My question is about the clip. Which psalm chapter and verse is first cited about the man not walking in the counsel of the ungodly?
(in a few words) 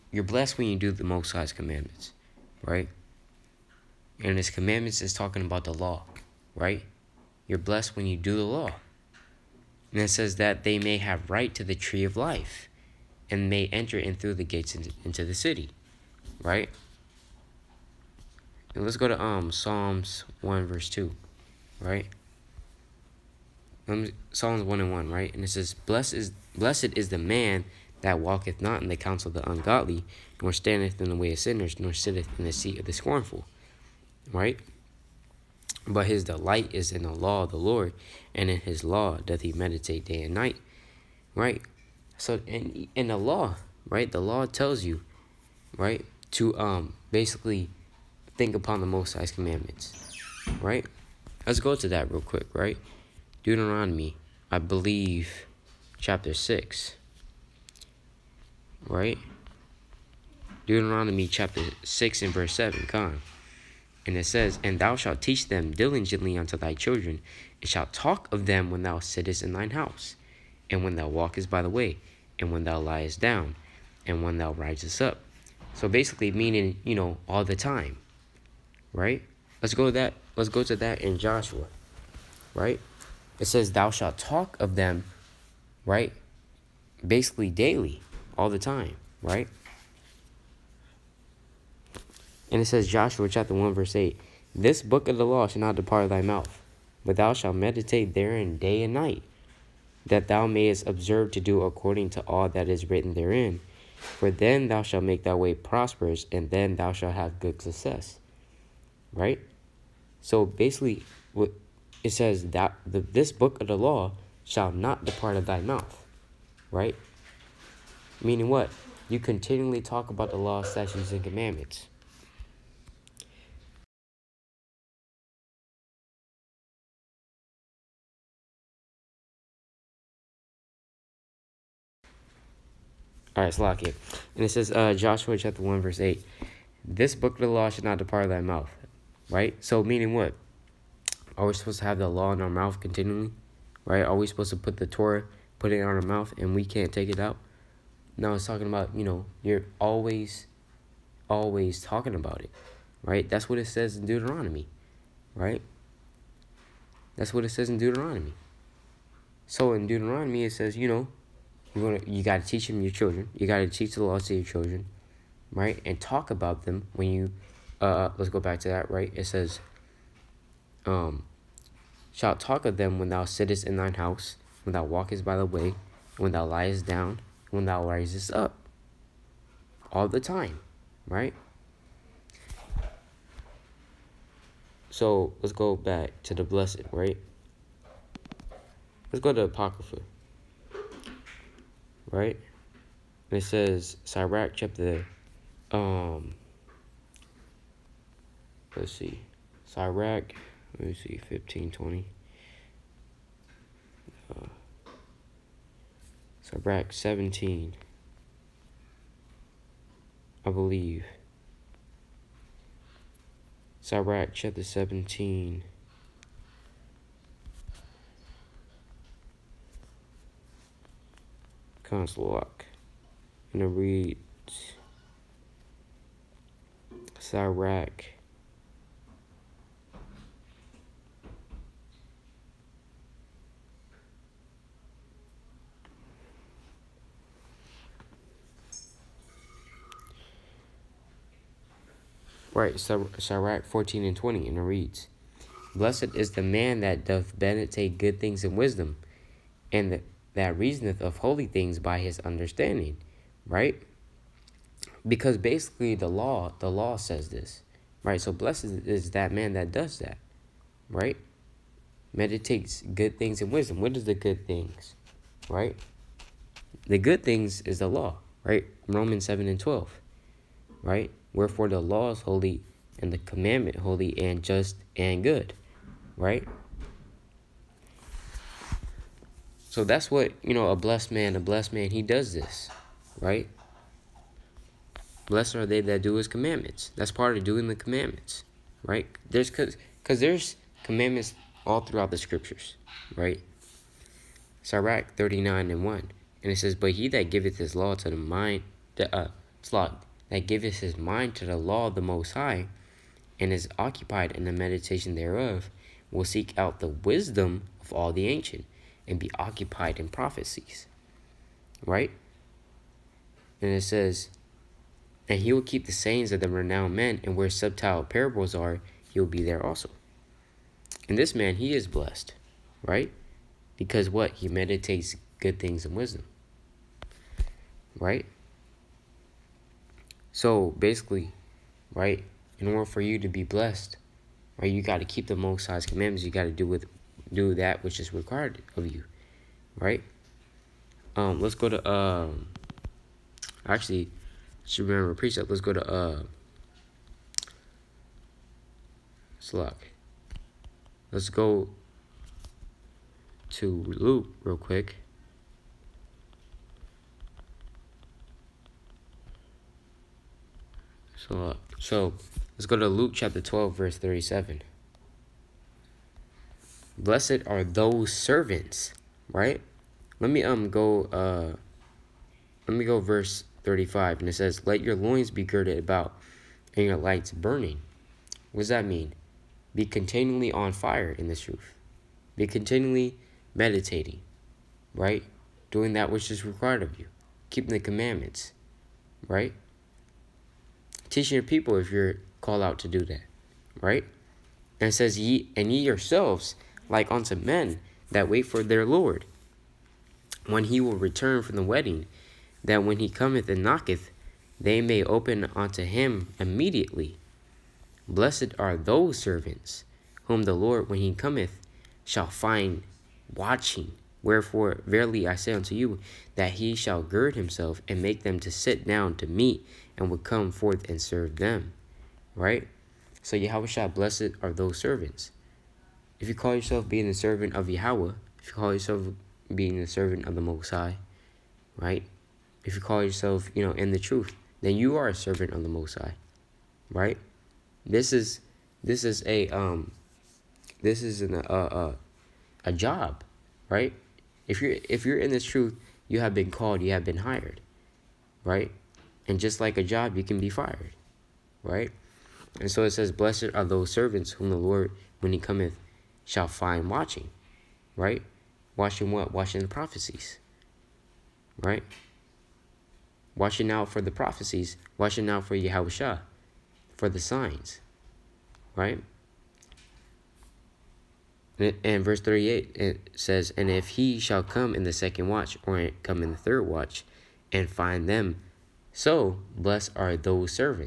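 Psalms 1:1.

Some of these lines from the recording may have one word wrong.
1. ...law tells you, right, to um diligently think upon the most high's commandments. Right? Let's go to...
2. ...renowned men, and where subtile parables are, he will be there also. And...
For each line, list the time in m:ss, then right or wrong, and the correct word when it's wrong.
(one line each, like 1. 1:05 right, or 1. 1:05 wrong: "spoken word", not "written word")
1. 0:44 wrong: "basically", not "diligently"
2. 5:16 right.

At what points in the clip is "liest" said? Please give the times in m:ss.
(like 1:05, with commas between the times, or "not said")
1:12, 2:56.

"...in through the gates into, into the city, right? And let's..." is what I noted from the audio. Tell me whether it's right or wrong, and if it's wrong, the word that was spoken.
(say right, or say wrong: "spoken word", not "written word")
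right.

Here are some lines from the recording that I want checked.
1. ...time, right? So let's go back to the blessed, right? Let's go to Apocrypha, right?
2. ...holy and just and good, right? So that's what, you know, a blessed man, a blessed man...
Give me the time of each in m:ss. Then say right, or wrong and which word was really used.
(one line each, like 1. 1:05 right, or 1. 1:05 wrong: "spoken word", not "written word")
1. 3:00 right
2. 4:33 right.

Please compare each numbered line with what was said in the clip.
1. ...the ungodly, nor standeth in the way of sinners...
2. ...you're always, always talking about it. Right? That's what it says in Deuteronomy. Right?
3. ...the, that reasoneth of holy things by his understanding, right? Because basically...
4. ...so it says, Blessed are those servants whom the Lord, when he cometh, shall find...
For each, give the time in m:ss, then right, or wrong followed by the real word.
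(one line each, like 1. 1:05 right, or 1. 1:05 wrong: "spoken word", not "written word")
1. 0:29 right
2. 2:29 right
3. 4:09 right
4. 7:32 right.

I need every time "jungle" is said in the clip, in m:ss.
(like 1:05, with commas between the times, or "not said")
not said.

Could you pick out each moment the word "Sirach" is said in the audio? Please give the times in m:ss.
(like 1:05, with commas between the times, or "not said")
3:14, 3:19, 3:33, 3:47, 4:54.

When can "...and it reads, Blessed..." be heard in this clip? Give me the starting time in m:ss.
4:04.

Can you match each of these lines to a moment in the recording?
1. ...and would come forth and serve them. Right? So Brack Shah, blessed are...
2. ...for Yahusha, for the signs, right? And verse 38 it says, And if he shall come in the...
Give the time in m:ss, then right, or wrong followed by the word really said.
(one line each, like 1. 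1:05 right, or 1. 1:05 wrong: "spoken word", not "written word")
1. 7:00 wrong: "Yahweh", not "Brack"
2. 7:45 right.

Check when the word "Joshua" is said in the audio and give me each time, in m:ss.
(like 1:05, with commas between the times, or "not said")
1:21, 1:32, 2:14.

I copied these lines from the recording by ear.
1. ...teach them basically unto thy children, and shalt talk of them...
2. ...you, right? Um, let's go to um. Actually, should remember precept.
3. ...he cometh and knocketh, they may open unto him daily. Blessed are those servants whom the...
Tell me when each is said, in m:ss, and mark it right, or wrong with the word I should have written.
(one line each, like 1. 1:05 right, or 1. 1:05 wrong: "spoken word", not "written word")
1. 1:05 wrong: "diligently", not "basically"
2. 5:38 right
3. 6:42 wrong: "immediately", not "daily".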